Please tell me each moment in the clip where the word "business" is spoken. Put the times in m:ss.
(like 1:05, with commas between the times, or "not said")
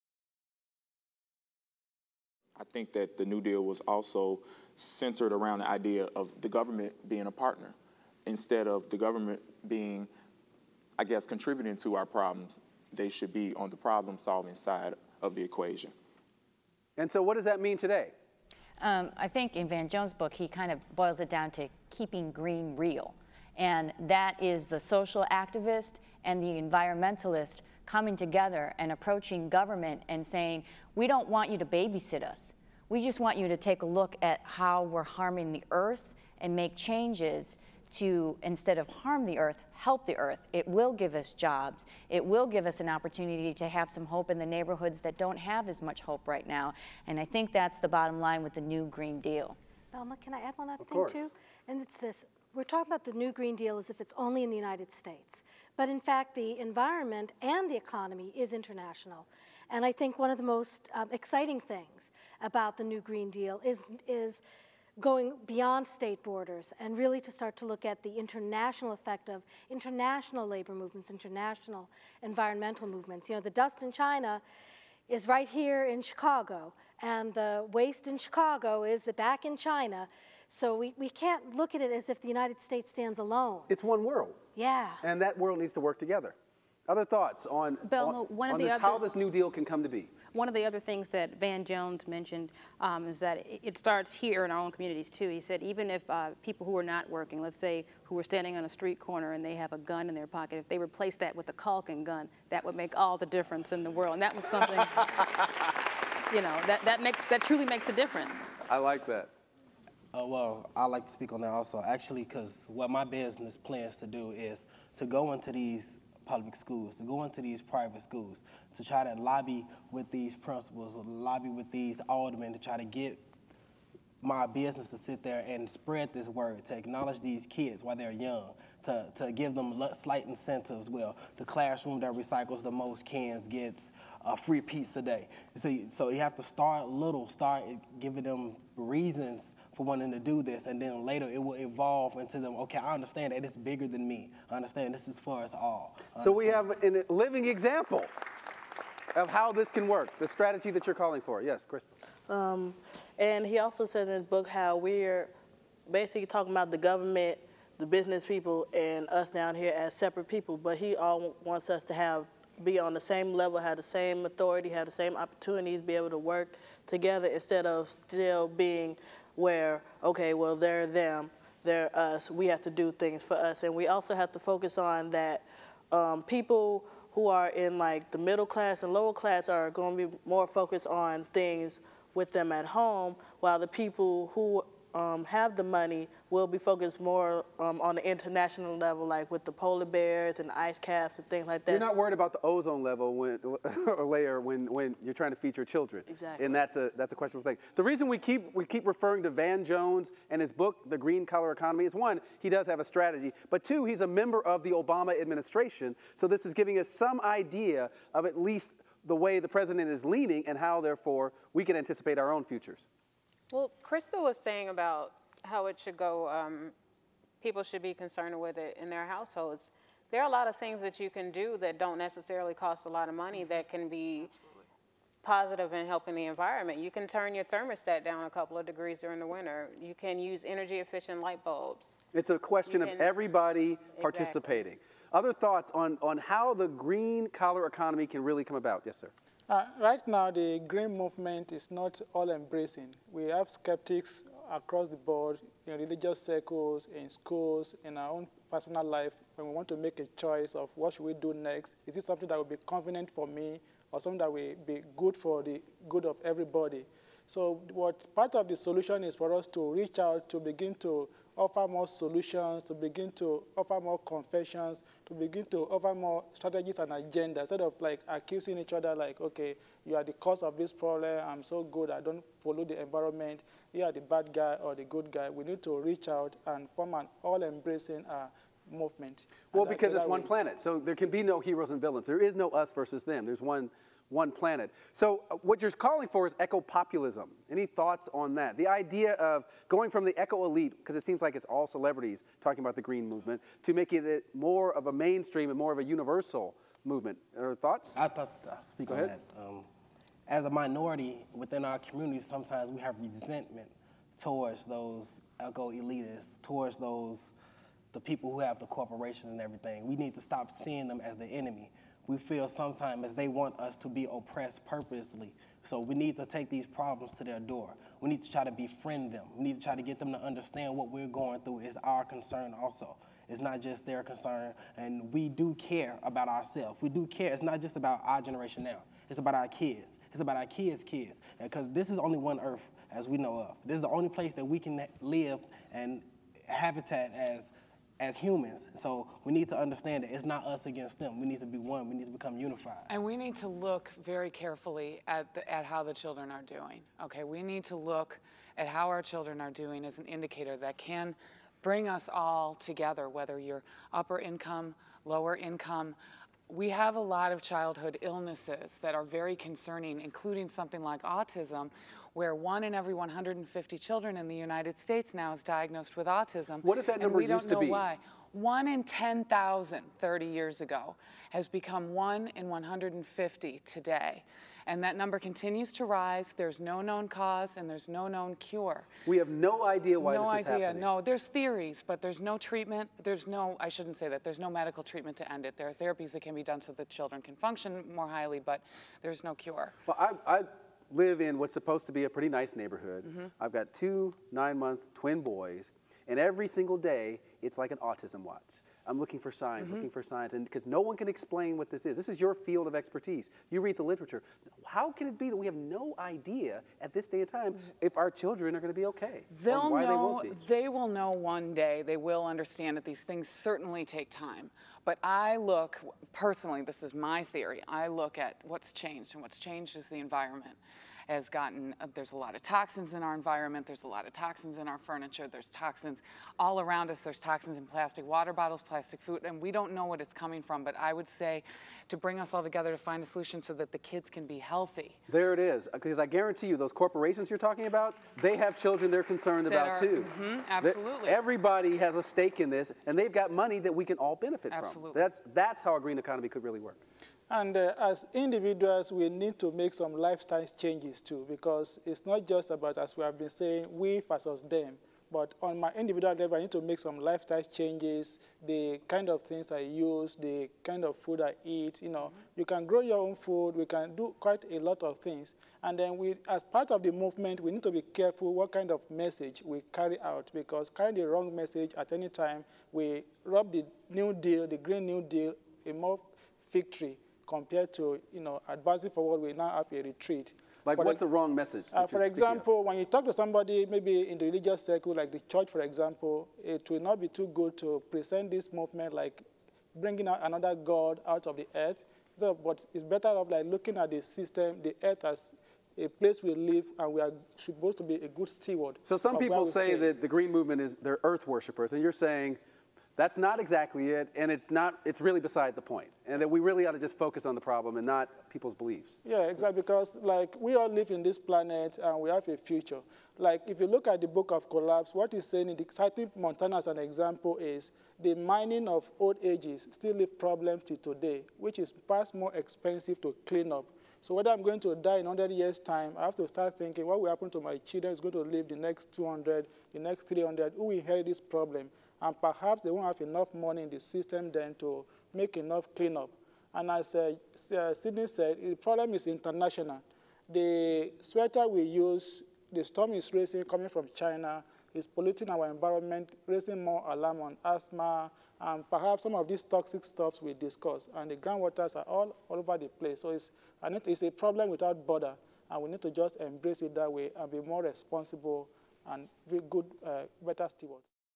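1:53, 2:04, 2:37.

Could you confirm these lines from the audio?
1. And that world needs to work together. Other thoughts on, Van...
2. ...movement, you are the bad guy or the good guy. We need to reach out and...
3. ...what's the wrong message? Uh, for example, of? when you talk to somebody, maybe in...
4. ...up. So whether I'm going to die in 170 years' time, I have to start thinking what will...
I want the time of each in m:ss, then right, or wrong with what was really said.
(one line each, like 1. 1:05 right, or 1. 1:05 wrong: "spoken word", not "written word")
1. 1:25 wrong: "Bill", not "Van"
2. 4:32 wrong: "environment", not "movement"
3. 8:00 right
4. 8:43 wrong: "100", not "170".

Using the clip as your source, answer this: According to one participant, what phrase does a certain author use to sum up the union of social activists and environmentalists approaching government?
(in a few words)
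keeping green real.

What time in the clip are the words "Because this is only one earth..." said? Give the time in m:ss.
5:31.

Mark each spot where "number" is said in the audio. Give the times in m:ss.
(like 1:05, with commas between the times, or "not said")
6:06, 6:14.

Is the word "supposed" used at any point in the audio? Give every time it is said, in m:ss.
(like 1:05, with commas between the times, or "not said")
6:31, 8:17.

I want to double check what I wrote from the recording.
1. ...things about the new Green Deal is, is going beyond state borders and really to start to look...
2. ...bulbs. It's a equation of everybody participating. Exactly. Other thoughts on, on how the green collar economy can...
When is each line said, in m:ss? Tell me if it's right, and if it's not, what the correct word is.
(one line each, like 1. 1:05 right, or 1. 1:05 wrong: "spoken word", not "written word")
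1. 1:01 right
2. 3:51 wrong: "question", not "equation".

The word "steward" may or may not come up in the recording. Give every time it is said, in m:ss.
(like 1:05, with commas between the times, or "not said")
8:18, 9:20.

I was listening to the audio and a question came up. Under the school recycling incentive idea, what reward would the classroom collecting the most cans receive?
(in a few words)
free pizza day.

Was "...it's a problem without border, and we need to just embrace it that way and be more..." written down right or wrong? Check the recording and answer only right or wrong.
right.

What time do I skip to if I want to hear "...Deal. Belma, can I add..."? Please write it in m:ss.
0:49.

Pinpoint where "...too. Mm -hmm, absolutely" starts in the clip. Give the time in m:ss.
7:19.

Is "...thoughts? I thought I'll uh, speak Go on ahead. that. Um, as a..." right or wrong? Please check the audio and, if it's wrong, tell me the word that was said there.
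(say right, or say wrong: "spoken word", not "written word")
right.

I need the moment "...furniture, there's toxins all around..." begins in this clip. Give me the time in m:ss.
7:04.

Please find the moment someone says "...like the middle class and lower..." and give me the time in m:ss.
2:57.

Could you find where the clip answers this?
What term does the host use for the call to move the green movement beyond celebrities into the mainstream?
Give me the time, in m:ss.
4:46.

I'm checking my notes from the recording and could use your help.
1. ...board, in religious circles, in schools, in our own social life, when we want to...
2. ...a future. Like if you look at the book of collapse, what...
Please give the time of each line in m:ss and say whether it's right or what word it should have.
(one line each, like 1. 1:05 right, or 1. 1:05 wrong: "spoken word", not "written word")
1. 4:04 wrong: "personal", not "social"
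2. 8:32 right.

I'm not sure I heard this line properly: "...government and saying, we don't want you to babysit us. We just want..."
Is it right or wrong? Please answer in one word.
right.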